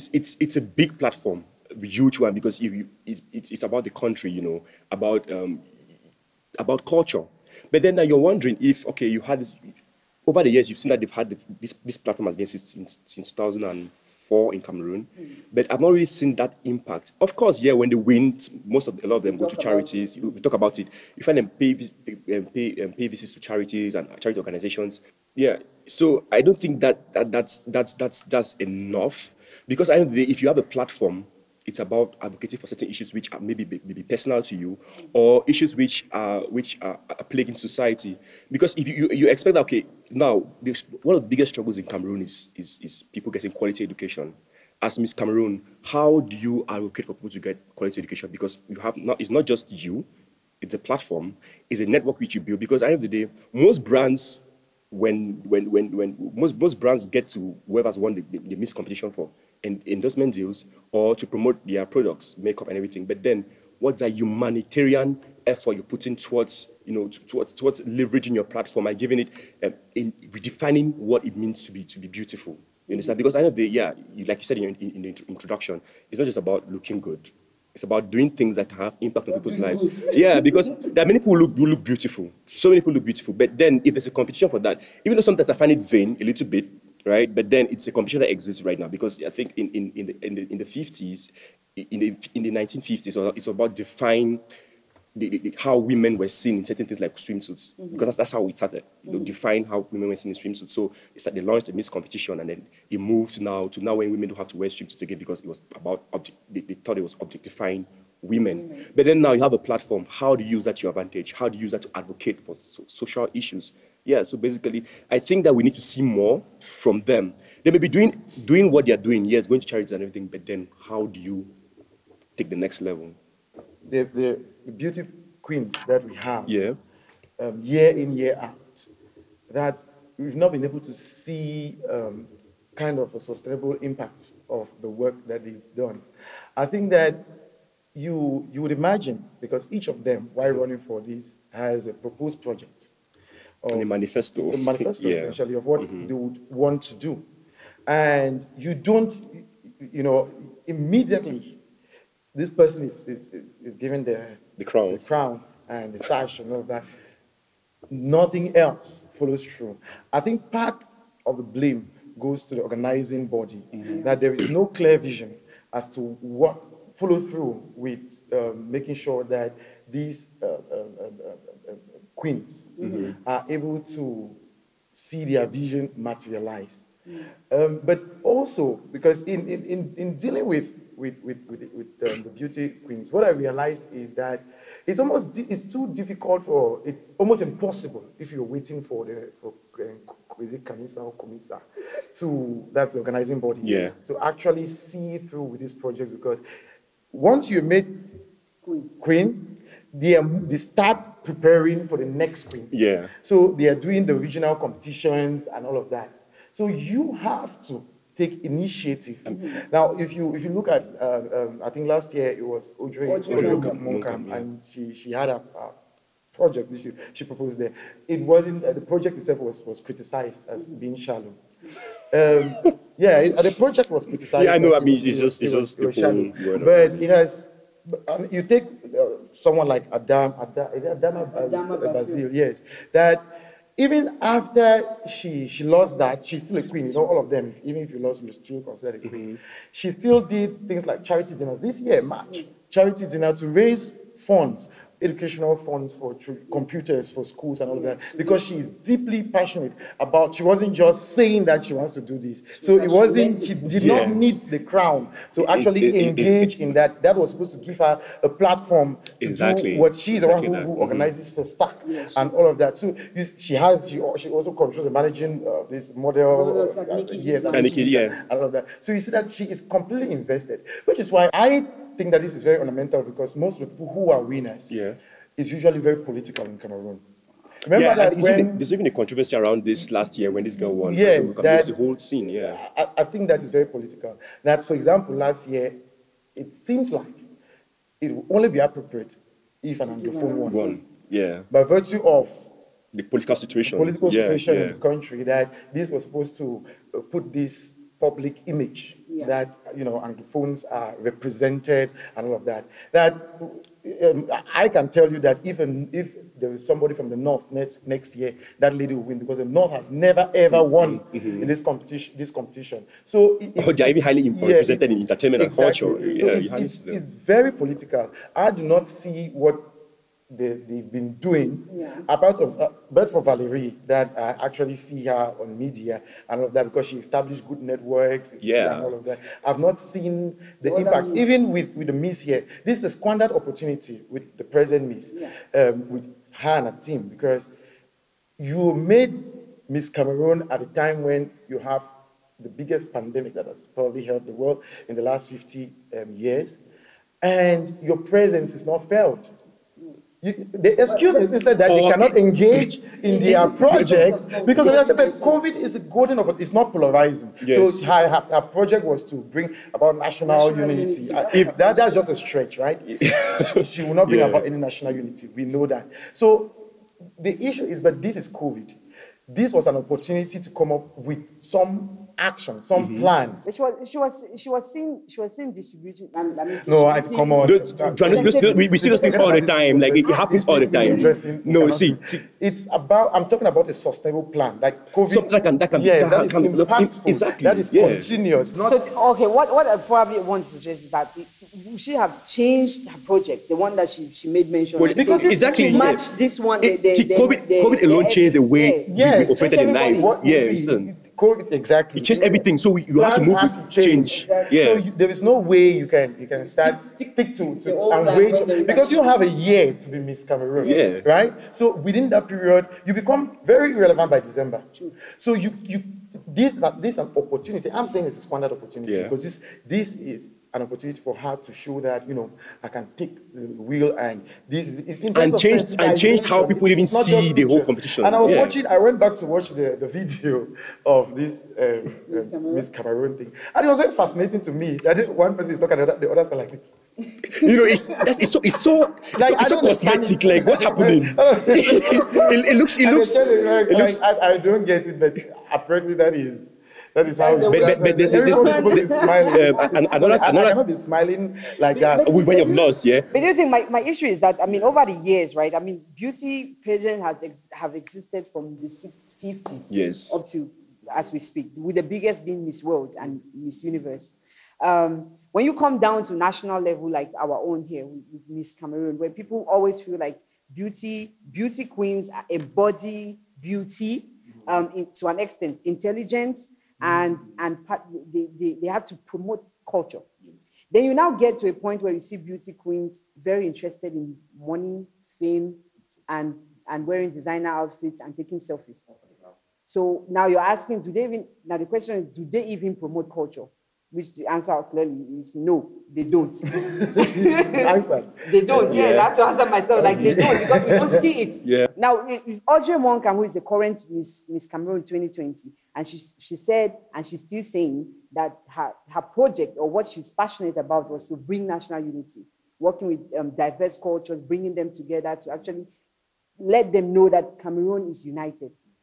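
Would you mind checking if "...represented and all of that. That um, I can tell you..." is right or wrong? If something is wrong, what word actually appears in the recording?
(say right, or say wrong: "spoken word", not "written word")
right.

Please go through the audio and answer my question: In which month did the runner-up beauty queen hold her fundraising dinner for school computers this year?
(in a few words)
March.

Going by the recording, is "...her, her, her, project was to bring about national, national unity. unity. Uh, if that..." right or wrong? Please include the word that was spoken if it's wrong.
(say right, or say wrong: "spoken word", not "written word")
right.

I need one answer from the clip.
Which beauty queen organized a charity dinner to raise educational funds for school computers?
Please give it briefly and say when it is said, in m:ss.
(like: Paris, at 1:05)
Adama Basil, at 3:51.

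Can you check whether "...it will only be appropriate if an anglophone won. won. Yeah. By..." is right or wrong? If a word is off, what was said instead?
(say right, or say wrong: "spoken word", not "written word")
right.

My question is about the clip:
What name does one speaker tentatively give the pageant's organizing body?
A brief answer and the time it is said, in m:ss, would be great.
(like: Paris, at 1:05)
Comisa, at 3:11.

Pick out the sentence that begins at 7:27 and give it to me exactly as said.
But, but, but this, this, this, smiling.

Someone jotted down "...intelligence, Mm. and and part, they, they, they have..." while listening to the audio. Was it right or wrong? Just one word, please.
right.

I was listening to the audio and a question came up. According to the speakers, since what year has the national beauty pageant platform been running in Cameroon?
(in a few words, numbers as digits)
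2004.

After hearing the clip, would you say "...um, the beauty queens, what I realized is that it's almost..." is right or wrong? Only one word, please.
right.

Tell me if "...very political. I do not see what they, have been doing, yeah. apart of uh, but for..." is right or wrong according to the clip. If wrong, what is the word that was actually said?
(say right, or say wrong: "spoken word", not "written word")
right.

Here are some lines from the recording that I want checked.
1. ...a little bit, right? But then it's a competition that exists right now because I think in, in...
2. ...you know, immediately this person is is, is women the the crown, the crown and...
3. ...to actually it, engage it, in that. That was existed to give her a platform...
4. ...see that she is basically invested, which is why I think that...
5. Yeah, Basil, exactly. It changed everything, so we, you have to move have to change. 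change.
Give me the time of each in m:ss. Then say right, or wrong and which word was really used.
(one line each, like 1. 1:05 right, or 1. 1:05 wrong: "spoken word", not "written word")
1. 1:26 right
2. 2:29 wrong: "given", not "women"
3. 4:15 wrong: "supposed", not "existed"
4. 4:29 wrong: "completely", not "basically"
5. 6:40 wrong: "COVID", not "Basil".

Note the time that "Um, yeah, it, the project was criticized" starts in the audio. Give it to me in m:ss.
3:42.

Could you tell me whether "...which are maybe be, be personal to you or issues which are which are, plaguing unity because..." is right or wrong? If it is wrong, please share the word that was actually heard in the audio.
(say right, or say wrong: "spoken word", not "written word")
wrong: "society", not "unity".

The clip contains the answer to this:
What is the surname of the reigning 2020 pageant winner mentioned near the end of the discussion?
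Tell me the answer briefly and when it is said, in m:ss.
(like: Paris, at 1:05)
Monkam, at 8:22.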